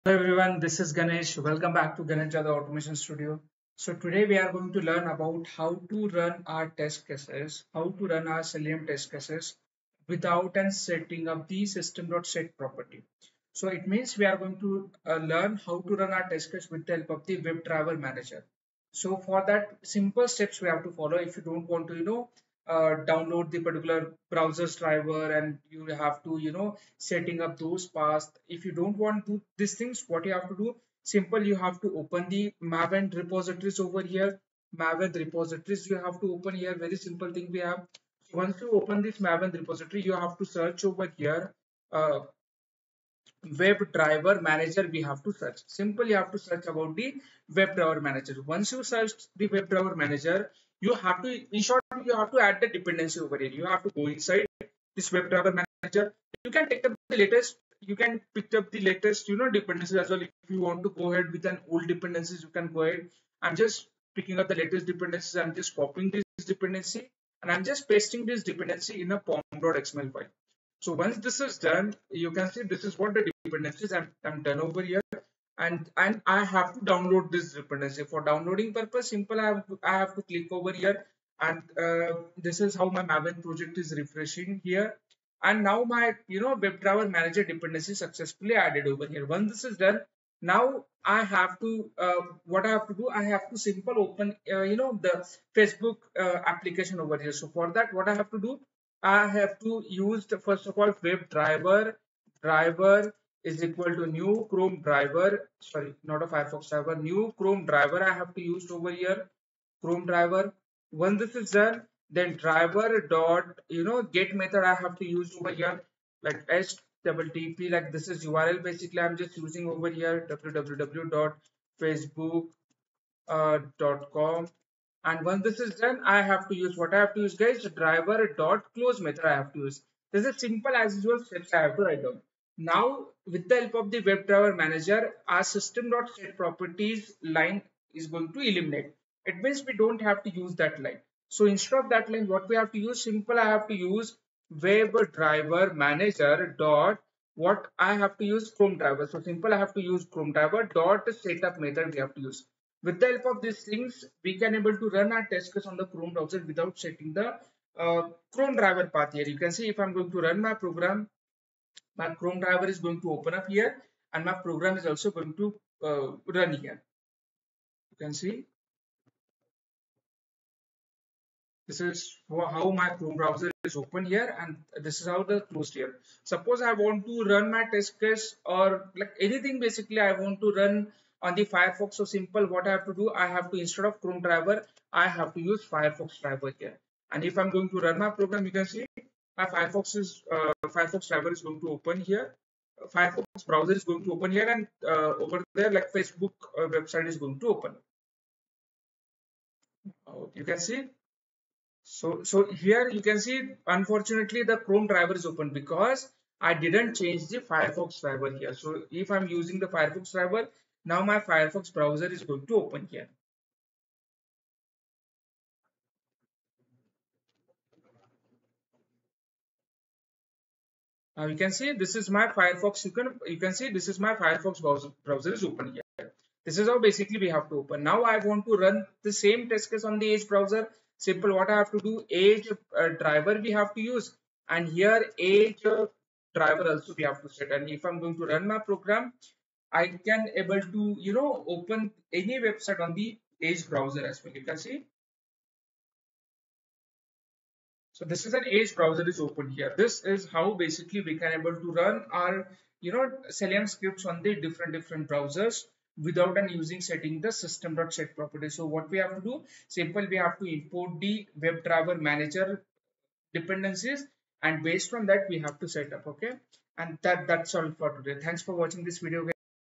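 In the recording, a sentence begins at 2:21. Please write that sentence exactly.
So instead of that line, what we have to use?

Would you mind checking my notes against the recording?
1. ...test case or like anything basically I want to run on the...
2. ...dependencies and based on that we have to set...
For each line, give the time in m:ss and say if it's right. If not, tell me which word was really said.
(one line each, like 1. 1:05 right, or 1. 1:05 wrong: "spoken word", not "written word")
1. 2:57 right
2. 4:23 right.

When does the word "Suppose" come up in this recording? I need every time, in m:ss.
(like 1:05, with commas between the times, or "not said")
2:56.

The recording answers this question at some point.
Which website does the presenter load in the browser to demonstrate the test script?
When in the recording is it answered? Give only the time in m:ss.
2:00.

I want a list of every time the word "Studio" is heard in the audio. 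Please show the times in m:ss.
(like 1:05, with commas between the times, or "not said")
0:02.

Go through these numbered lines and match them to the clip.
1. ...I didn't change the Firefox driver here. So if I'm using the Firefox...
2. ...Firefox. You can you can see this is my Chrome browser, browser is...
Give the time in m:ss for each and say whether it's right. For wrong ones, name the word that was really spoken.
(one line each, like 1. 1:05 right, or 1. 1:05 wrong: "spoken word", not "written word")
1. 3:26 right
2. 3:42 wrong: "Firefox", not "Chrome".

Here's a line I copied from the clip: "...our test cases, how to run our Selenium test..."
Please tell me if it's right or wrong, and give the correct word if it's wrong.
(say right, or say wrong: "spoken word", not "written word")
right.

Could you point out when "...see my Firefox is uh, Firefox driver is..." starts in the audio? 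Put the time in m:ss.
3:08.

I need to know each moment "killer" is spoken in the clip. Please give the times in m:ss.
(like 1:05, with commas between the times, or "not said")
not said.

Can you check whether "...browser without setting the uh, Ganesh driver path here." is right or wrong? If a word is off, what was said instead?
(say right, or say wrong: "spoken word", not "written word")
wrong: "Chrome", not "Ganesh".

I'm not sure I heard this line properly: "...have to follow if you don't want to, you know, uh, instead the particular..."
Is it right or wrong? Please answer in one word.
wrong.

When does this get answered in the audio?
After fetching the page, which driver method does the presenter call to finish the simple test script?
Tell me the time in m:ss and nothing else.
2:07.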